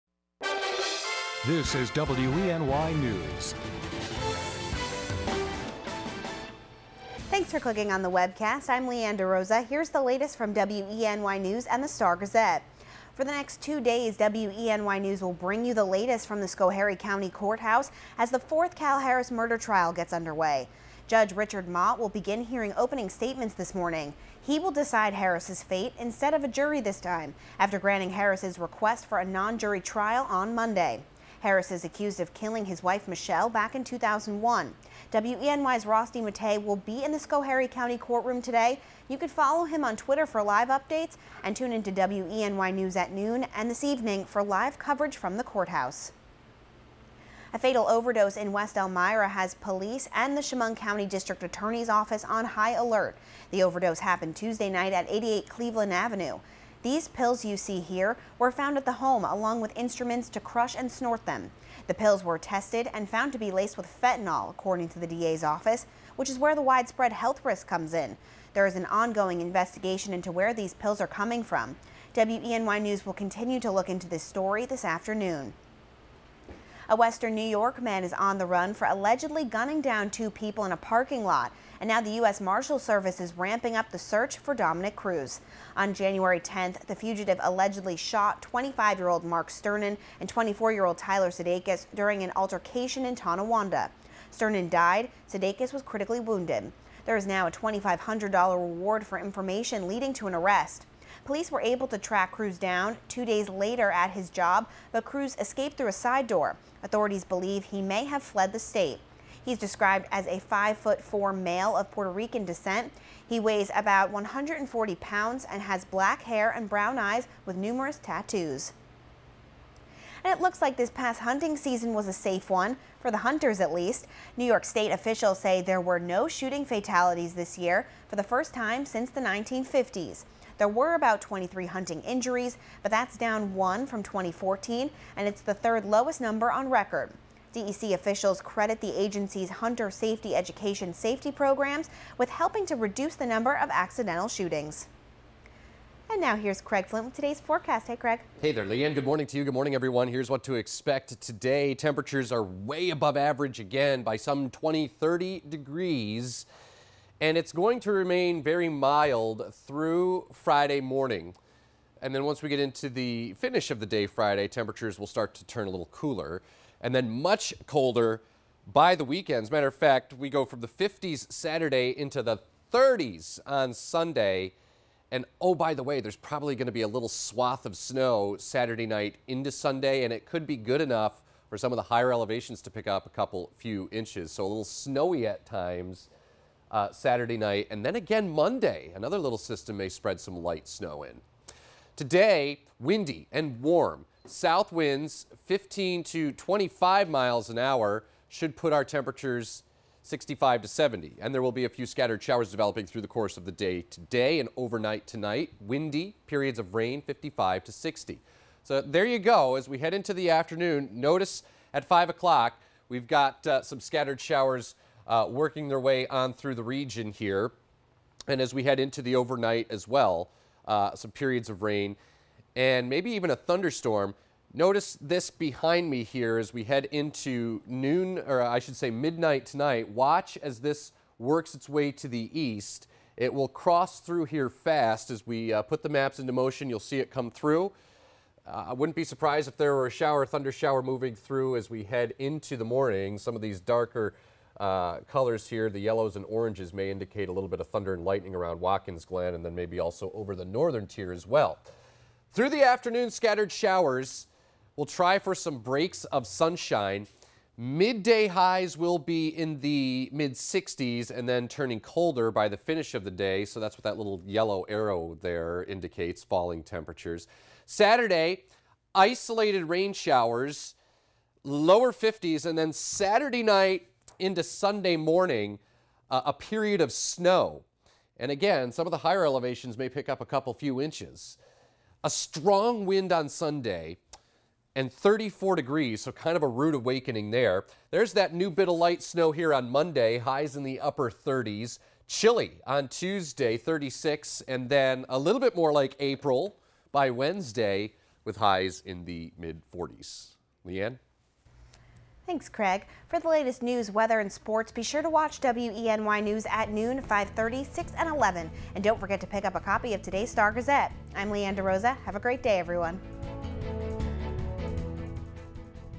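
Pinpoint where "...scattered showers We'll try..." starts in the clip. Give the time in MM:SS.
04:13.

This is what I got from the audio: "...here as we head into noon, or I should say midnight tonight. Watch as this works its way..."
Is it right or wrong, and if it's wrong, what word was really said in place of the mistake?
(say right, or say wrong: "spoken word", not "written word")
right.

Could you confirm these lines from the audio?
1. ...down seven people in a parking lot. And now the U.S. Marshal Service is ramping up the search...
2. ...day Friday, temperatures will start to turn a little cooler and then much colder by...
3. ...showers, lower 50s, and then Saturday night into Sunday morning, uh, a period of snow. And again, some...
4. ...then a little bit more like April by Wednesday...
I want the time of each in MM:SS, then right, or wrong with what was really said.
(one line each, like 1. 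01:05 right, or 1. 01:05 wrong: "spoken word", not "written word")
1. 01:19 wrong: "two", not "seven"
2. 02:43 right
3. 04:29 right
4. 04:54 right.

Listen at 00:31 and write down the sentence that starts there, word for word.
Harris is accused of killing his wife Michelle back in 2001.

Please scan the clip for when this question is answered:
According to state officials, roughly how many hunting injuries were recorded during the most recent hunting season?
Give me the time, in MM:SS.
02:11.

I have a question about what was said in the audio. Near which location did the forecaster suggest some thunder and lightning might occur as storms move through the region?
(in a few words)
Watkins Glen.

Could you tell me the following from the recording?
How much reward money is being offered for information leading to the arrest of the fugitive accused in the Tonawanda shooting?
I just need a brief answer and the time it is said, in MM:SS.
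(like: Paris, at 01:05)
$2,500, at 01:37.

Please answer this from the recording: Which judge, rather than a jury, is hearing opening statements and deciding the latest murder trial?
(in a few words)
Richard Mott.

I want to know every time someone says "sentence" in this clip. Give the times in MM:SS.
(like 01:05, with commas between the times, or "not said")
not said.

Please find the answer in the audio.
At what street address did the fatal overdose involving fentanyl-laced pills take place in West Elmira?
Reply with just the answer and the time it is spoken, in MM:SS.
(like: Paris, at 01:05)
88 Cleveland Avenue, at 00:55.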